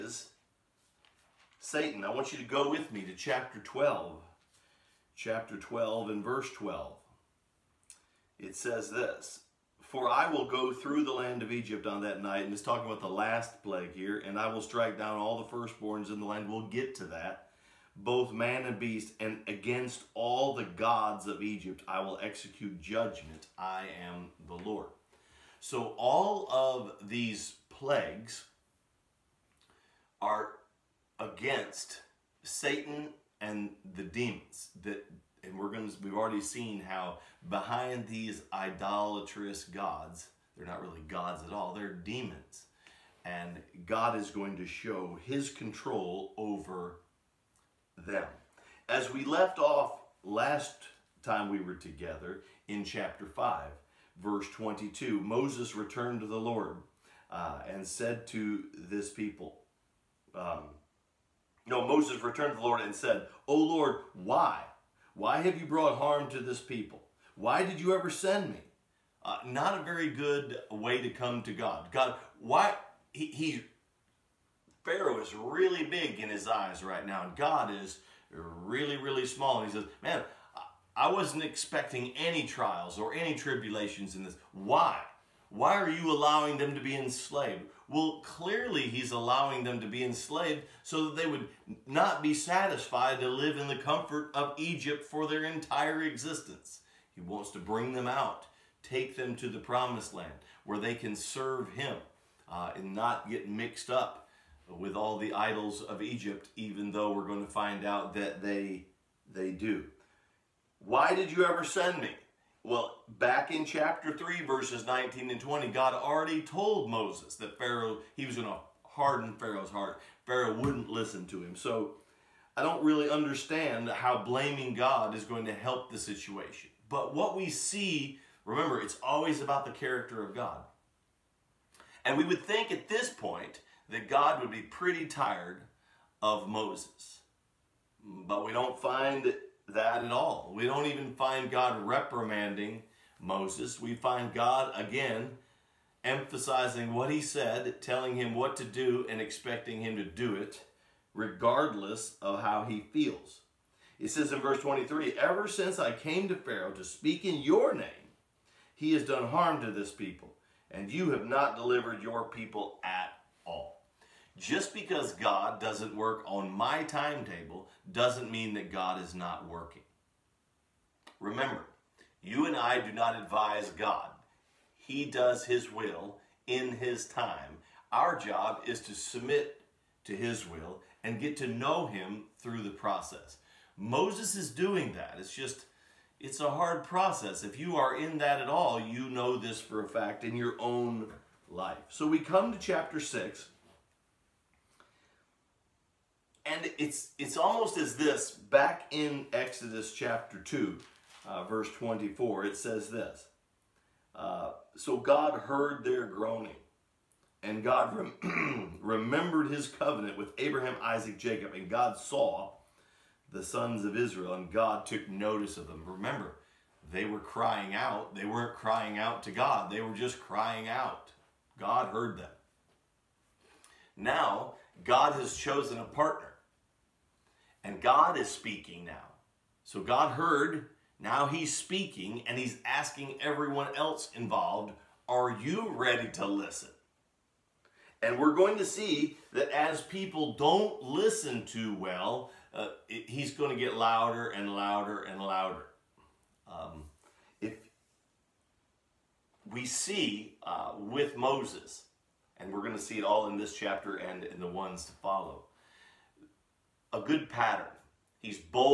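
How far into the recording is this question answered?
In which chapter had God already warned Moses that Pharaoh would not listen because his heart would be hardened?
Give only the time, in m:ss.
1:53.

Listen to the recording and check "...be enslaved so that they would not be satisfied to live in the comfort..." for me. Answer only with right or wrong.
right.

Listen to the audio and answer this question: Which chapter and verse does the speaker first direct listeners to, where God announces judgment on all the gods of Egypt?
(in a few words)
Chapter 12, verse 12.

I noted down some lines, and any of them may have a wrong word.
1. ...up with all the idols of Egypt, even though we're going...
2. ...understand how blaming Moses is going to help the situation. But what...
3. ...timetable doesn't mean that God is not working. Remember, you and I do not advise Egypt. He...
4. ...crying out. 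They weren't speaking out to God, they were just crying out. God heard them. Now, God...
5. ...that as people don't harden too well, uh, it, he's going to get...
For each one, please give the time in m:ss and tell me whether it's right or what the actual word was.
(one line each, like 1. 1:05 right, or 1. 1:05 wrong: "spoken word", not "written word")
1. 1:43 right
2. 2:03 wrong: "God", not "Moses"
3. 2:46 wrong: "God", not "Egypt"
4. 3:37 wrong: "crying", not "speaking"
5. 3:59 wrong: "listen", not "harden".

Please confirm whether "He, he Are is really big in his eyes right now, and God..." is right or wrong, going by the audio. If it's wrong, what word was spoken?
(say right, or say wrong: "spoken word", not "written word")
wrong: "Pharaoh", not "Are".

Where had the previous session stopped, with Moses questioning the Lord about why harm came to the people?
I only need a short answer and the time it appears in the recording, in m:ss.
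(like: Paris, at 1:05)
Chapter 5, verse 22, at 0:52.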